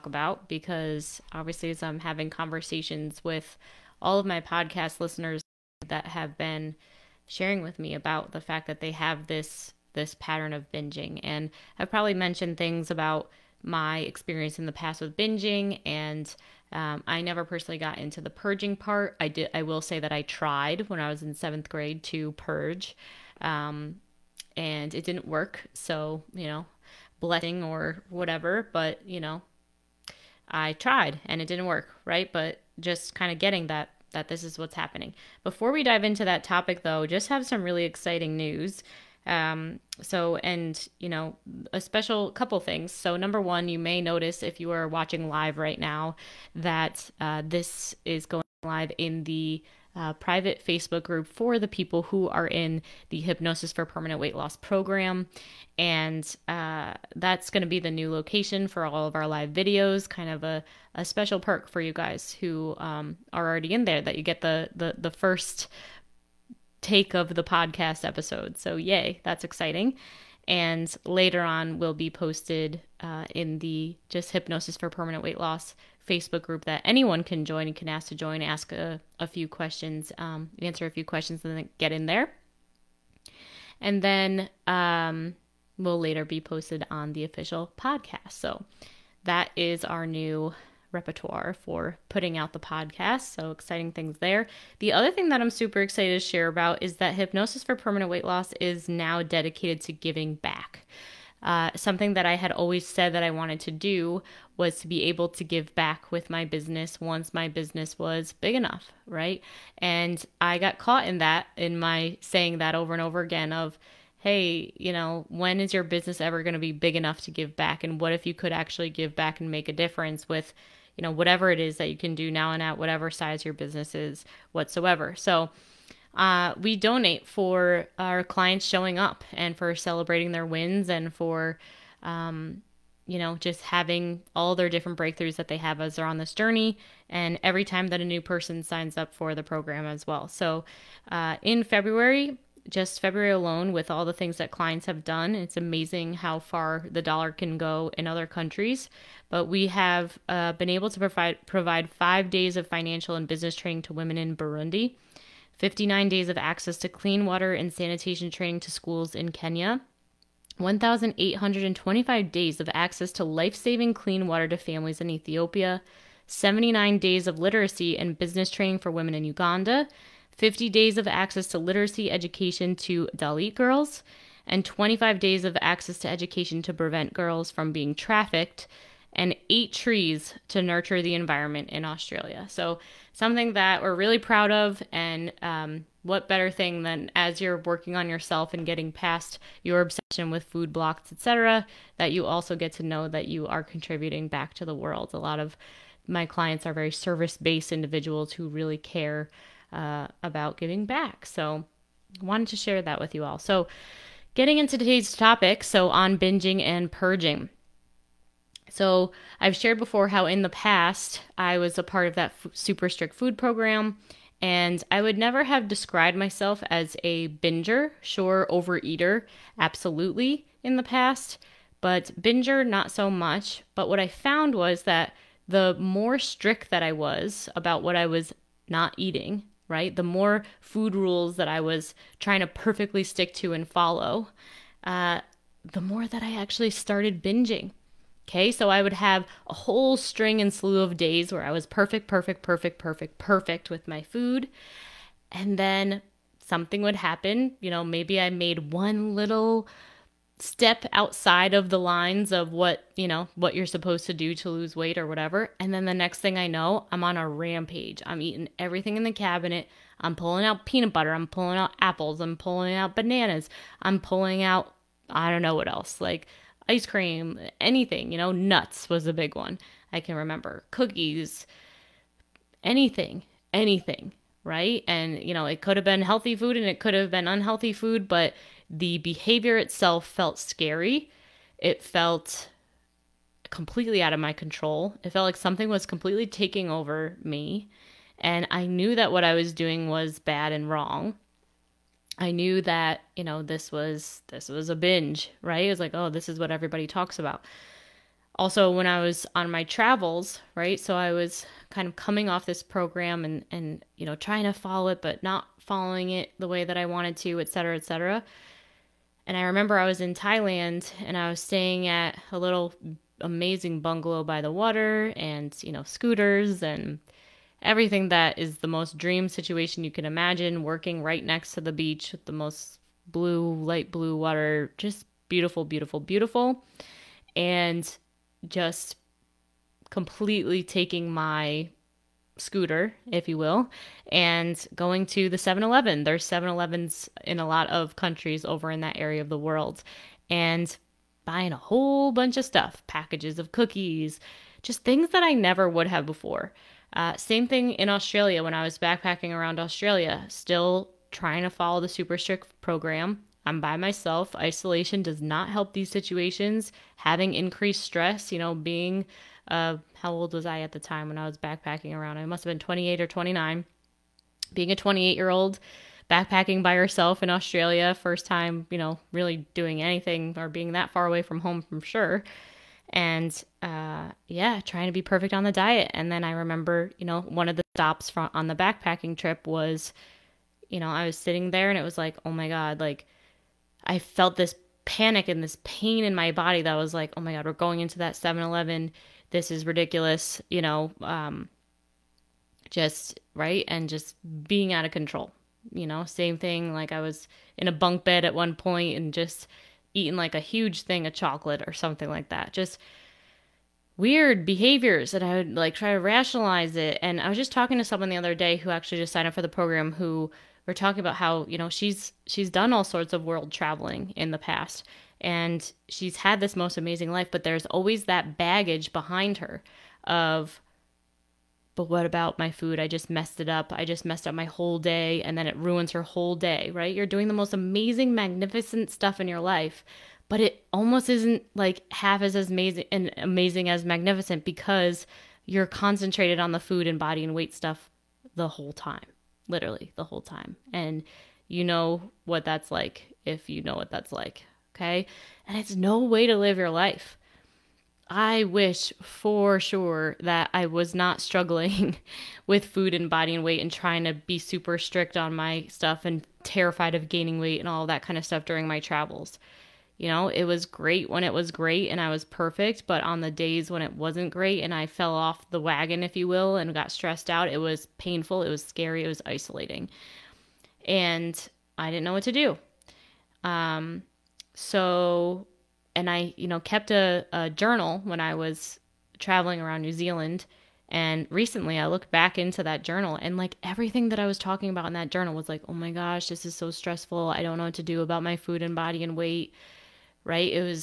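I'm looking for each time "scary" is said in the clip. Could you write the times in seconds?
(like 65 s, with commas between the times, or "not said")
280 s, 468 s.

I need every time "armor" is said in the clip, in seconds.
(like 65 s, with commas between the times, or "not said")
not said.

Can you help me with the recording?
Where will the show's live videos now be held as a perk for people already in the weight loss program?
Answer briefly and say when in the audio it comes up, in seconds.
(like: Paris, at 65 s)
Private Facebook group, at 50 s.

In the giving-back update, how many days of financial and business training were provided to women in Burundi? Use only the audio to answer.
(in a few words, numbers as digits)
5.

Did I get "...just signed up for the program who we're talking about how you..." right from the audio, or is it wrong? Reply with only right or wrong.
right.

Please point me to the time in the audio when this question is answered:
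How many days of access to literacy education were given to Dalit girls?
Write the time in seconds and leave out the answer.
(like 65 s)
170 s.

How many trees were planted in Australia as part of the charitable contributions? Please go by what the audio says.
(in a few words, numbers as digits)
8.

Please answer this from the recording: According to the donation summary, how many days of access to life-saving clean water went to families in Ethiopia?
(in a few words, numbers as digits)
1,825.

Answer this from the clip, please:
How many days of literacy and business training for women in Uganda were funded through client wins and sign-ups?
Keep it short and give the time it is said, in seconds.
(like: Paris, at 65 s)
79, at 166 s.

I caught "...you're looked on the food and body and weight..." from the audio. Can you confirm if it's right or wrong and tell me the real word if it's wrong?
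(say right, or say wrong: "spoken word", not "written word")
wrong: "concentrated", not "looked".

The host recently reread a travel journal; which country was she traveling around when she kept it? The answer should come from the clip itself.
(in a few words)
New Zealand.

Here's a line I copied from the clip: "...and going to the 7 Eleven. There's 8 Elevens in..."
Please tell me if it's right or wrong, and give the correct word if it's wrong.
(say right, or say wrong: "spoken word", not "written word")
wrong: "7", not "8".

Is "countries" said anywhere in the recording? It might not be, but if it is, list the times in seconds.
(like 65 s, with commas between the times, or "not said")
148 s, 337 s.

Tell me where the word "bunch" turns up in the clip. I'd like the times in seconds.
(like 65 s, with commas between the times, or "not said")
342 s.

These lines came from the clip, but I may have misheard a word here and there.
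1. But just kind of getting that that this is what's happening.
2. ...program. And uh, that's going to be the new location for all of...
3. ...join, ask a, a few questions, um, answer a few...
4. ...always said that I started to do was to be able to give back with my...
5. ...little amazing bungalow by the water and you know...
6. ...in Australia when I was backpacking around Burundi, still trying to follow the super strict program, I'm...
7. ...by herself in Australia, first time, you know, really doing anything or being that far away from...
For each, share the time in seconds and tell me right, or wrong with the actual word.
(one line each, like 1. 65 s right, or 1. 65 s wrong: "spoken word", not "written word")
1. 32 s right
2. 54 s right
3. 78 s right
4. 102 s wrong: "wanted", not "started"
5. 312 s right
6. 347 s wrong: "Australia", not "Burundi"
7. 366 s right.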